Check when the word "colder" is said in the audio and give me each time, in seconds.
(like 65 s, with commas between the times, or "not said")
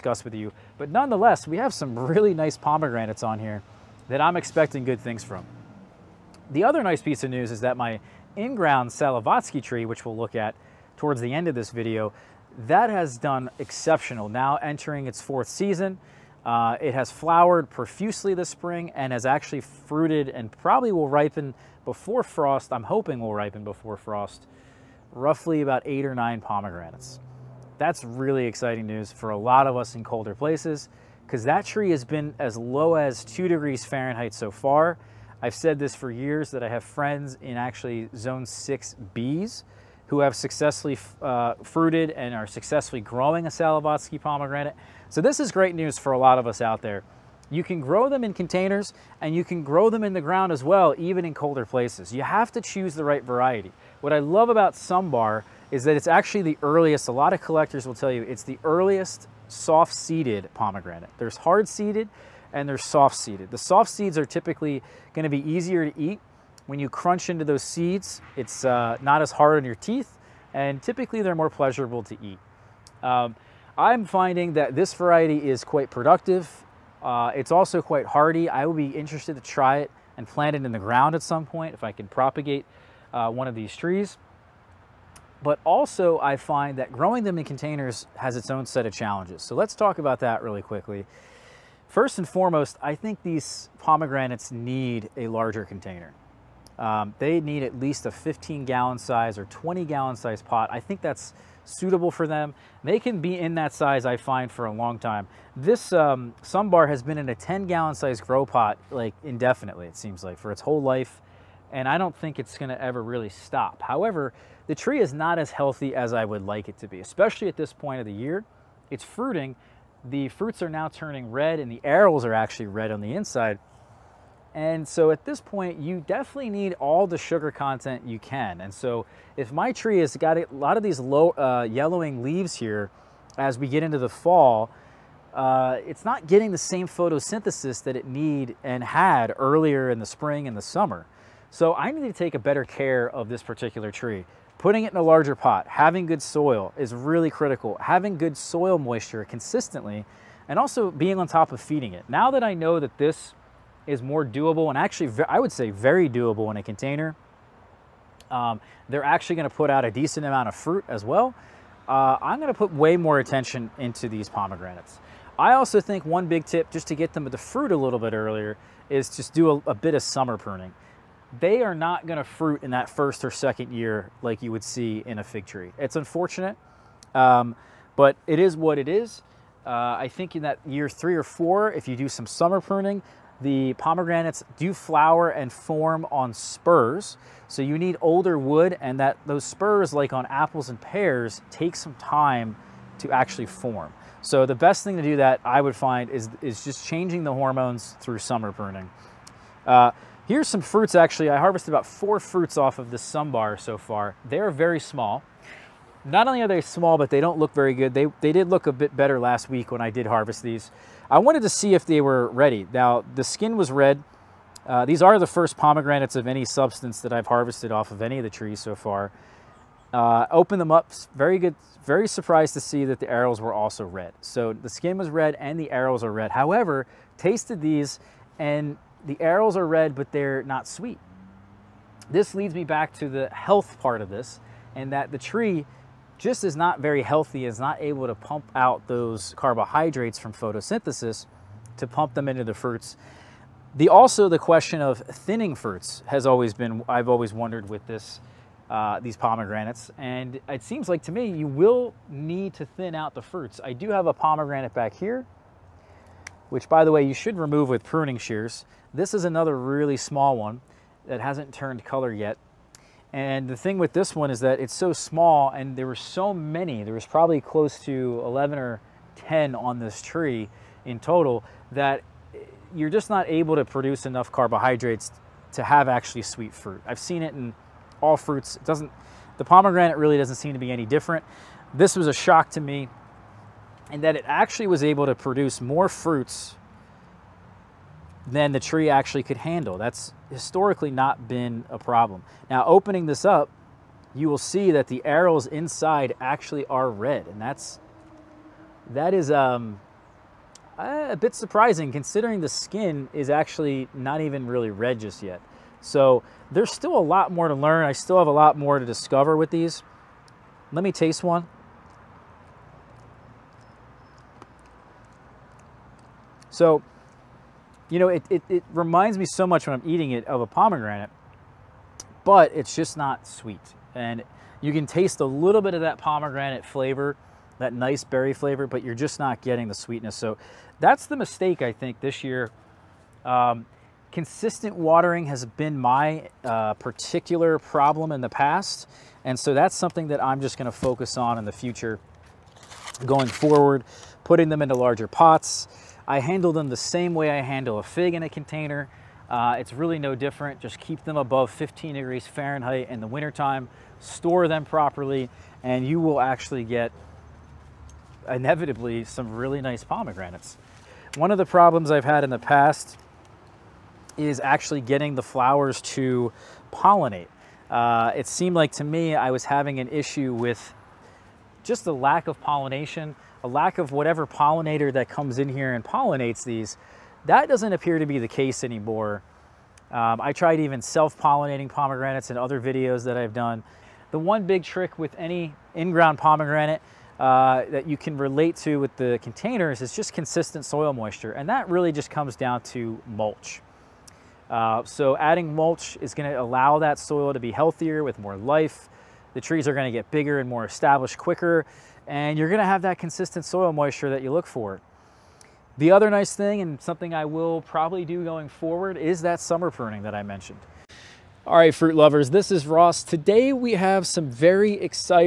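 30 s, 51 s.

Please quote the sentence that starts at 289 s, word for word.
That's historically not been a problem.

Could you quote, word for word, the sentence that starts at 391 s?
And that really just comes down to mulch.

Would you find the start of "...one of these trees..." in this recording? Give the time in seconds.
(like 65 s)
83 s.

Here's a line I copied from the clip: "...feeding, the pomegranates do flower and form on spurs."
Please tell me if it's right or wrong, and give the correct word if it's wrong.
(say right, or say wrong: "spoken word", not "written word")
wrong: "pruning", not "feeding".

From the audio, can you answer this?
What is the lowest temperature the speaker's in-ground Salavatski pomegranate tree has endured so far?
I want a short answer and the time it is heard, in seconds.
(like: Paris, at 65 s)
2 degrees Fahrenheit, at 33 s.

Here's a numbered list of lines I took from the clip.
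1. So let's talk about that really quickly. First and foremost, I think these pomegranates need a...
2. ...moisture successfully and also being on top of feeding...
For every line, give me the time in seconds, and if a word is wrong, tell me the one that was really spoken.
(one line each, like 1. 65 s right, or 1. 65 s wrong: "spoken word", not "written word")
1. 89 s right
2. 148 s wrong: "consistently", not "successfully".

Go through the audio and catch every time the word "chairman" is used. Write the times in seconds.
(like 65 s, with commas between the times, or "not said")
not said.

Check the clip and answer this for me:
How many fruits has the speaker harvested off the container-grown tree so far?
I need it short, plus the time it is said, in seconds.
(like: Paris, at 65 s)
4, at 201 s.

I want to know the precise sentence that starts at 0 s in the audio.
But nonetheless, we have some really nice pomegranates on here that I'm expecting good things from.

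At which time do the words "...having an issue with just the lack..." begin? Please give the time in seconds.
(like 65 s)
369 s.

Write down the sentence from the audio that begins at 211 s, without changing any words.
I wanted to see if they were ready.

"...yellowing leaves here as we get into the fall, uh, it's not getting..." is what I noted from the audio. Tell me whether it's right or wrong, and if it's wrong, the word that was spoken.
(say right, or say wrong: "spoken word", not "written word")
right.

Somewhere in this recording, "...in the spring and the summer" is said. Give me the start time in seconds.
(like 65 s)
139 s.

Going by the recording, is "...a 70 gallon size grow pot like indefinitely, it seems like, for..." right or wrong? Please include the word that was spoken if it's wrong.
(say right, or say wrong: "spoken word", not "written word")
wrong: "10", not "70".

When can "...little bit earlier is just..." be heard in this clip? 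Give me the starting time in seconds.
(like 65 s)
167 s.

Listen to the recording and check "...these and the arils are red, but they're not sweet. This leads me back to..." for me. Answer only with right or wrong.
right.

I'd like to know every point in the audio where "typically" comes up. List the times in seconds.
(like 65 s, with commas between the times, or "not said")
64 s, 70 s.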